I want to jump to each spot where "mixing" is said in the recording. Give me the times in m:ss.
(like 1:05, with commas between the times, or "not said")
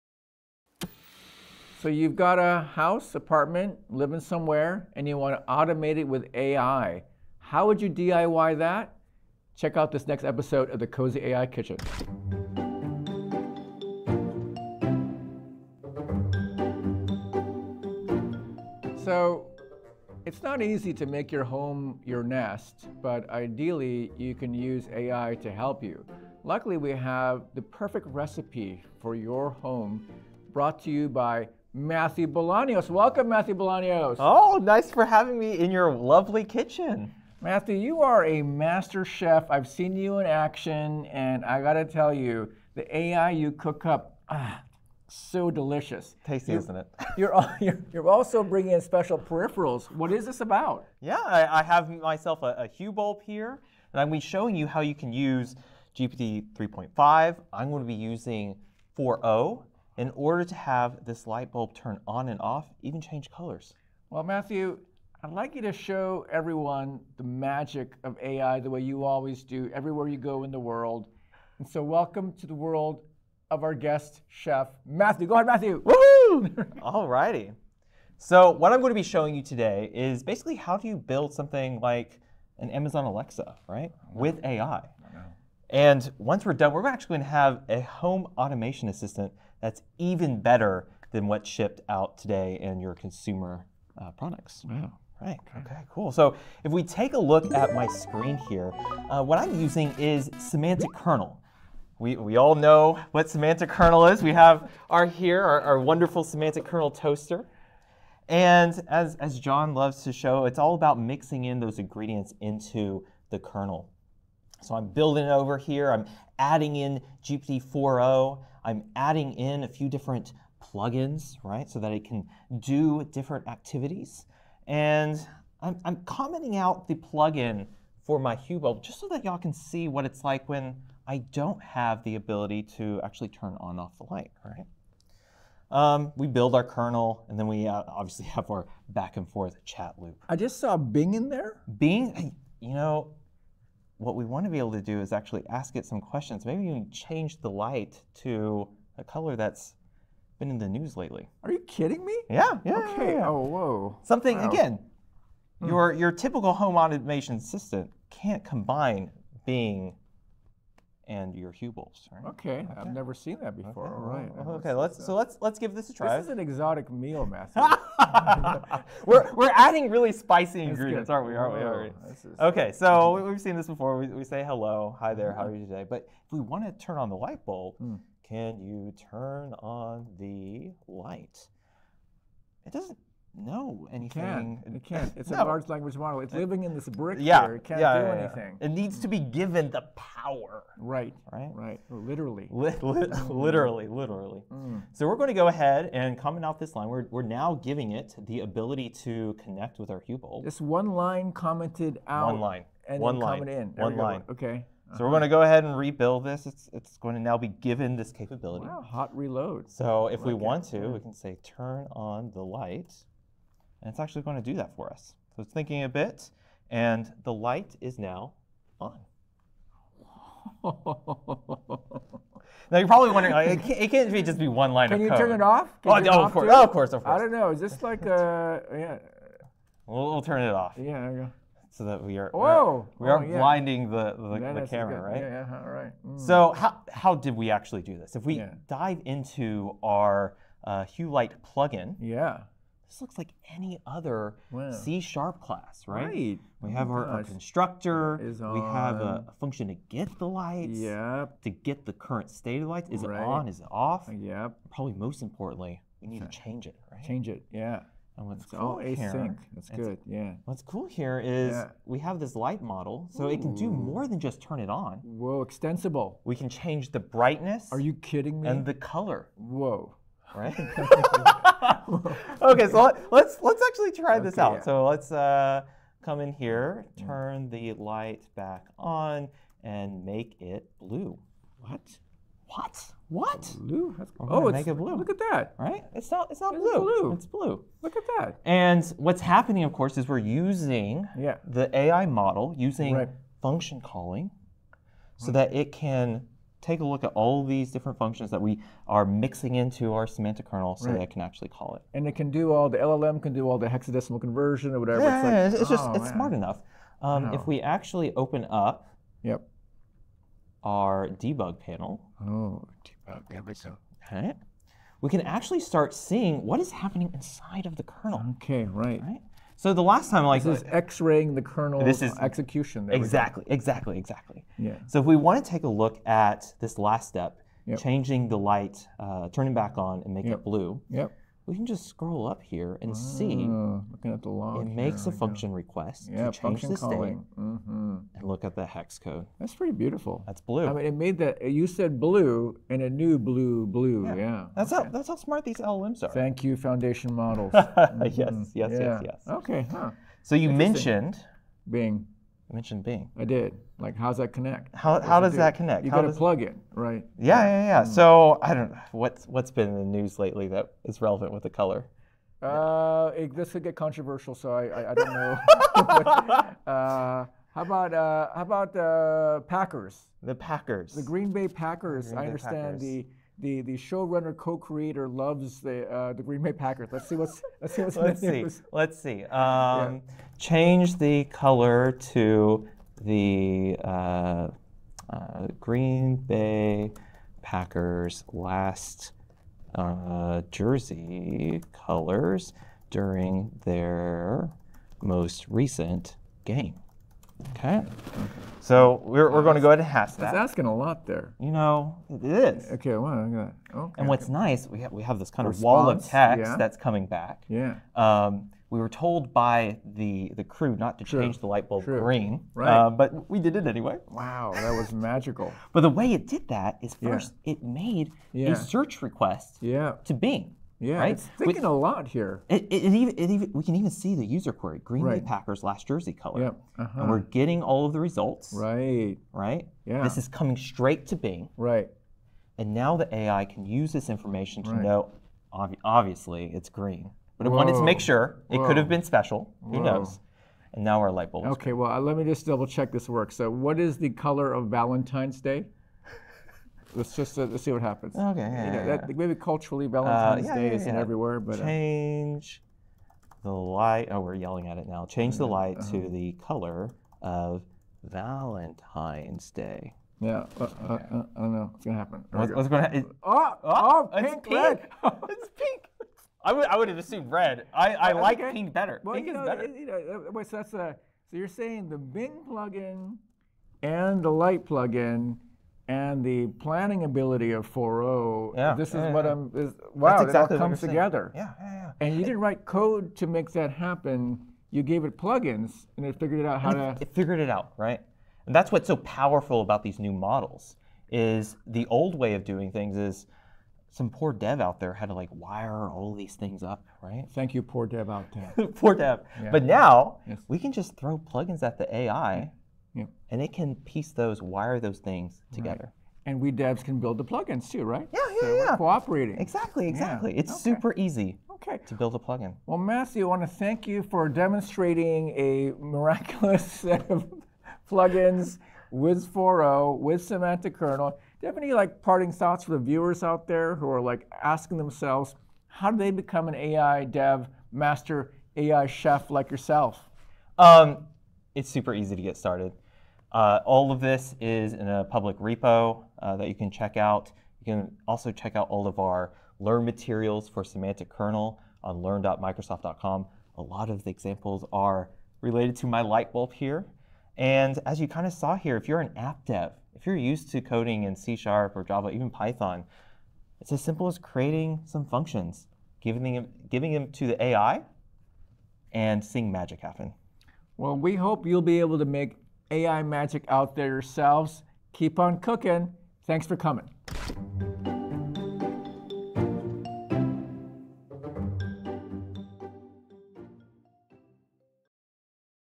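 1:50, 4:59.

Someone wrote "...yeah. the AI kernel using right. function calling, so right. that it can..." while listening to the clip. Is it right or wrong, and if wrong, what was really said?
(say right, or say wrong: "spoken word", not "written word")
wrong: "model", not "kernel".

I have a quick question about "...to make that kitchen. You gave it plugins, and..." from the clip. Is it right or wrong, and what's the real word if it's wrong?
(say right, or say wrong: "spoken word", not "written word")
wrong: "happen", not "kitchen".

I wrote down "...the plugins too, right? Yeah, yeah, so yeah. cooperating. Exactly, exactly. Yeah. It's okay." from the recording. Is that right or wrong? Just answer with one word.
right.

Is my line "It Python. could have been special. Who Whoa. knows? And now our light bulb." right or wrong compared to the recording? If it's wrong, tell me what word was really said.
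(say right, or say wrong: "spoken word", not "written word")
wrong: "Whoa", not "Python".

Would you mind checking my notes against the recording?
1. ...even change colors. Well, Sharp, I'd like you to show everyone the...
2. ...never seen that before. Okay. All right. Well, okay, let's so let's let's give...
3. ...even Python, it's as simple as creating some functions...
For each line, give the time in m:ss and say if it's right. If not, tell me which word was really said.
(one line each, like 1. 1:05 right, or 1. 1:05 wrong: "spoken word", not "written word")
1. 1:02 wrong: "Matthew", not "Sharp"
2. 2:42 right
3. 9:12 right.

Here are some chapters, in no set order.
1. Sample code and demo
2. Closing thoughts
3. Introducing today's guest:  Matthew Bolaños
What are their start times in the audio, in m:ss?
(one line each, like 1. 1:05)
1. 1:39
2. 7:52
3. 0:18.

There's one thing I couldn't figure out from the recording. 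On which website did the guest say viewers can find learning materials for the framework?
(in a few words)
learn.microsoft.com.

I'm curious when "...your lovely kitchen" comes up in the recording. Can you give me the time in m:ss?
0:35.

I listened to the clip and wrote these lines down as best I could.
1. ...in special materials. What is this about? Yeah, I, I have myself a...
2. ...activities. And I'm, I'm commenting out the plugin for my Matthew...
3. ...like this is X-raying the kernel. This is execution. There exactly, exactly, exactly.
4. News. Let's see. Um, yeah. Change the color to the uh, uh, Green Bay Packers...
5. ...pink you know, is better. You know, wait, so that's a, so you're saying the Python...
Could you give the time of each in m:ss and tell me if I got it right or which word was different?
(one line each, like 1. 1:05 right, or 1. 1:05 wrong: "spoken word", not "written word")
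1. 0:48 wrong: "peripherals", not "materials"
2. 2:03 wrong: "Hue", not "Matthew"
3. 5:20 right
4. 6:18 right
5. 7:49 wrong: "Bing", not "Python".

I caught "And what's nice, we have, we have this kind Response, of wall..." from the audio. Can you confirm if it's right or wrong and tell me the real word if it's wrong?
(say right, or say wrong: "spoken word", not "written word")
right.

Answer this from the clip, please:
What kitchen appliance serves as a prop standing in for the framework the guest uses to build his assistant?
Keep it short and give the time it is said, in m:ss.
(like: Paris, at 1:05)
Toaster, at 1:46.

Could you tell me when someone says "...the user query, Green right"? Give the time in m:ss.
7:04.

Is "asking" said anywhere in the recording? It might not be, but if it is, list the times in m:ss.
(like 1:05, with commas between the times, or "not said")
6:40, 8:44.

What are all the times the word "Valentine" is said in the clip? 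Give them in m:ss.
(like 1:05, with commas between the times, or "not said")
7:24, 7:29, 7:38.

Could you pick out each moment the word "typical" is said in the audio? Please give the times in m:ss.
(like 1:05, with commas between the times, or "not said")
2:36.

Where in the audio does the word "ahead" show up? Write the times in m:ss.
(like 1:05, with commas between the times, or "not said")
1:15, 3:15, 3:25, 6:39.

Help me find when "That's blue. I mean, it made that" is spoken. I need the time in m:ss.
5:40.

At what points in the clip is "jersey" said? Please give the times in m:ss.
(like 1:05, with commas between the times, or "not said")
6:30, 7:05.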